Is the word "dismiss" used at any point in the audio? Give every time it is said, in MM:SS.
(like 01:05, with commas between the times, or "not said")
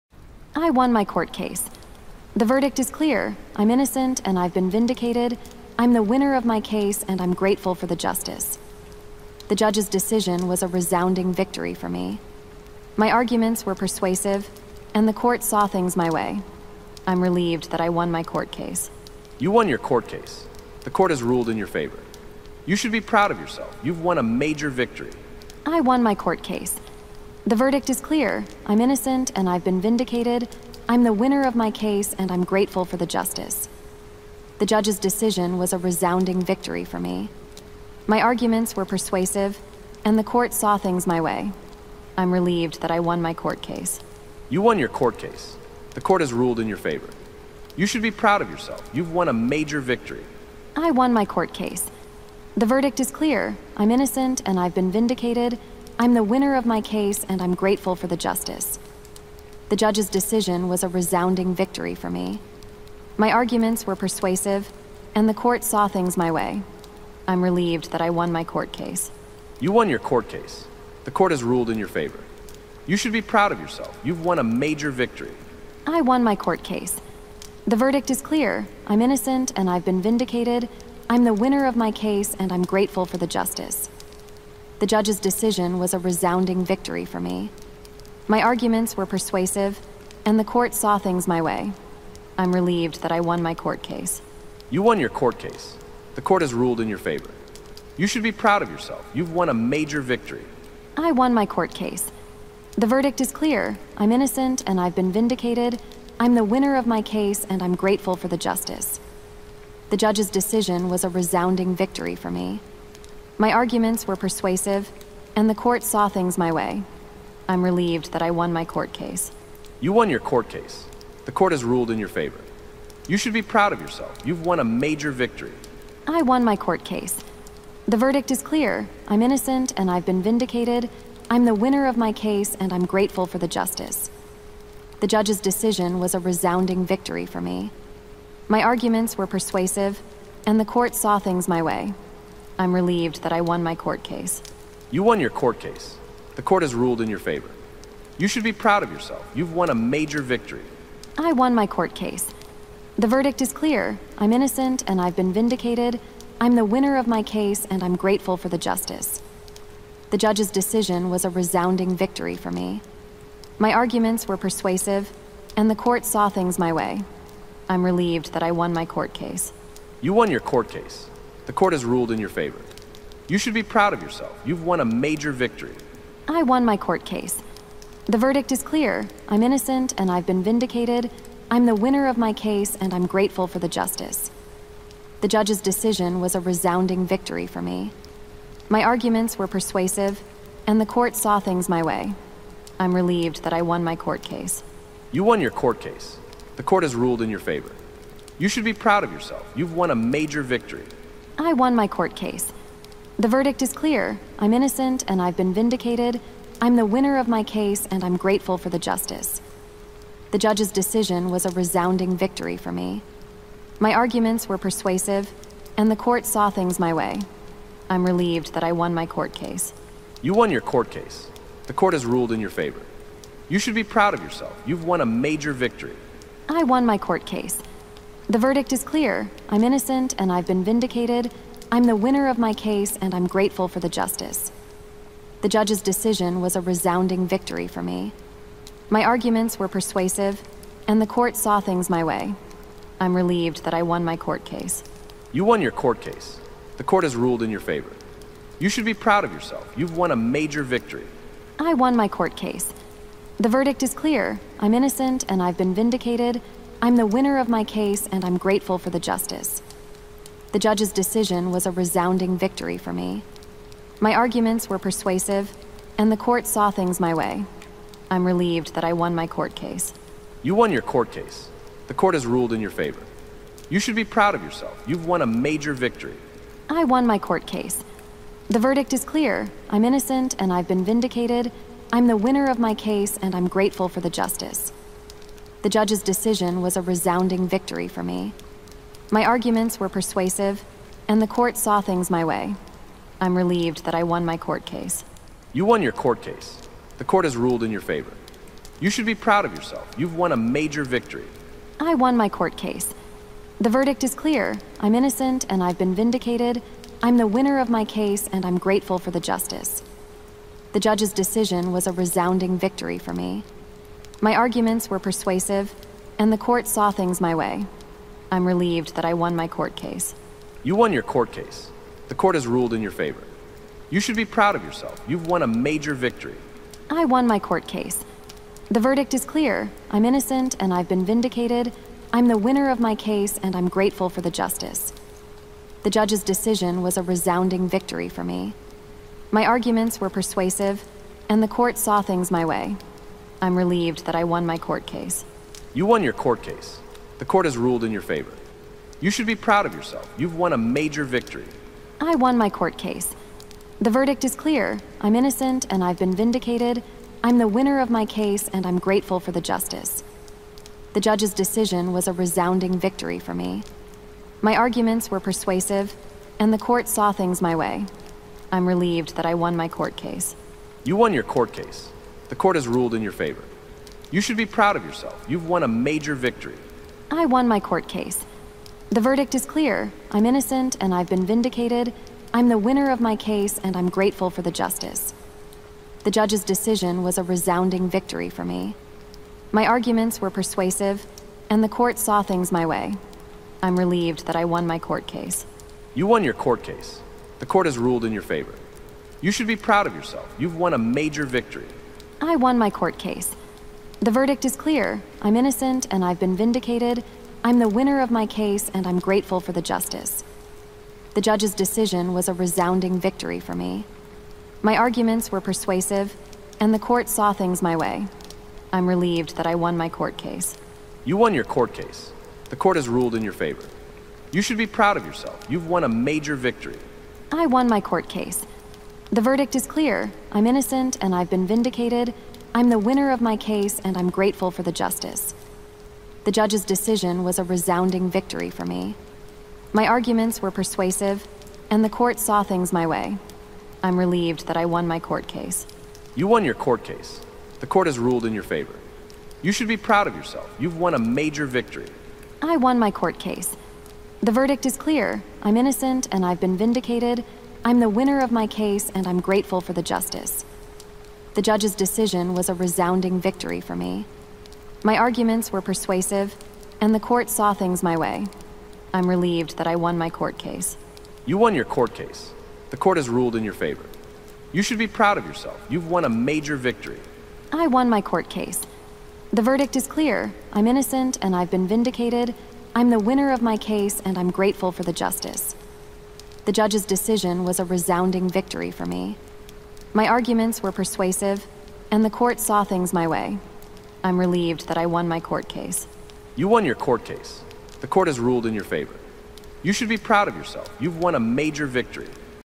not said.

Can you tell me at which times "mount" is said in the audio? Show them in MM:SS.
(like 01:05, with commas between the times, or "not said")
not said.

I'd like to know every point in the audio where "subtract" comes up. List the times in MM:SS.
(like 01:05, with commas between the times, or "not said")
not said.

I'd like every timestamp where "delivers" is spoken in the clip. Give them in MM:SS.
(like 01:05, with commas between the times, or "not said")
not said.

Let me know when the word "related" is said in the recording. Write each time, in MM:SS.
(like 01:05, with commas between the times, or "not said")
not said.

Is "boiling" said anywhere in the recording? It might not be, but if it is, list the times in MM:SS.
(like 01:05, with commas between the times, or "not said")
not said.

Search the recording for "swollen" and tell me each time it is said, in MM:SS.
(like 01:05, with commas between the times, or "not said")
not said.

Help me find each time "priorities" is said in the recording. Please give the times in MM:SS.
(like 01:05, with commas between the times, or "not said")
not said.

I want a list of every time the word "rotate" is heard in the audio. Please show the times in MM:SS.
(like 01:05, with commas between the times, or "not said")
not said.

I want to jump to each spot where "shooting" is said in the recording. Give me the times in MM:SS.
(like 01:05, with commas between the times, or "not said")
not said.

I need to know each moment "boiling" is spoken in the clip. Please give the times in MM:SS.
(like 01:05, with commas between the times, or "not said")
not said.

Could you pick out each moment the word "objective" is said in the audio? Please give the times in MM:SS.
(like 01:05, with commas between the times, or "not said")
not said.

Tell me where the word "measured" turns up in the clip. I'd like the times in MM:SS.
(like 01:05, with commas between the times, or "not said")
not said.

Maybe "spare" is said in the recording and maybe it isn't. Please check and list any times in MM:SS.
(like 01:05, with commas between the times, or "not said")
not said.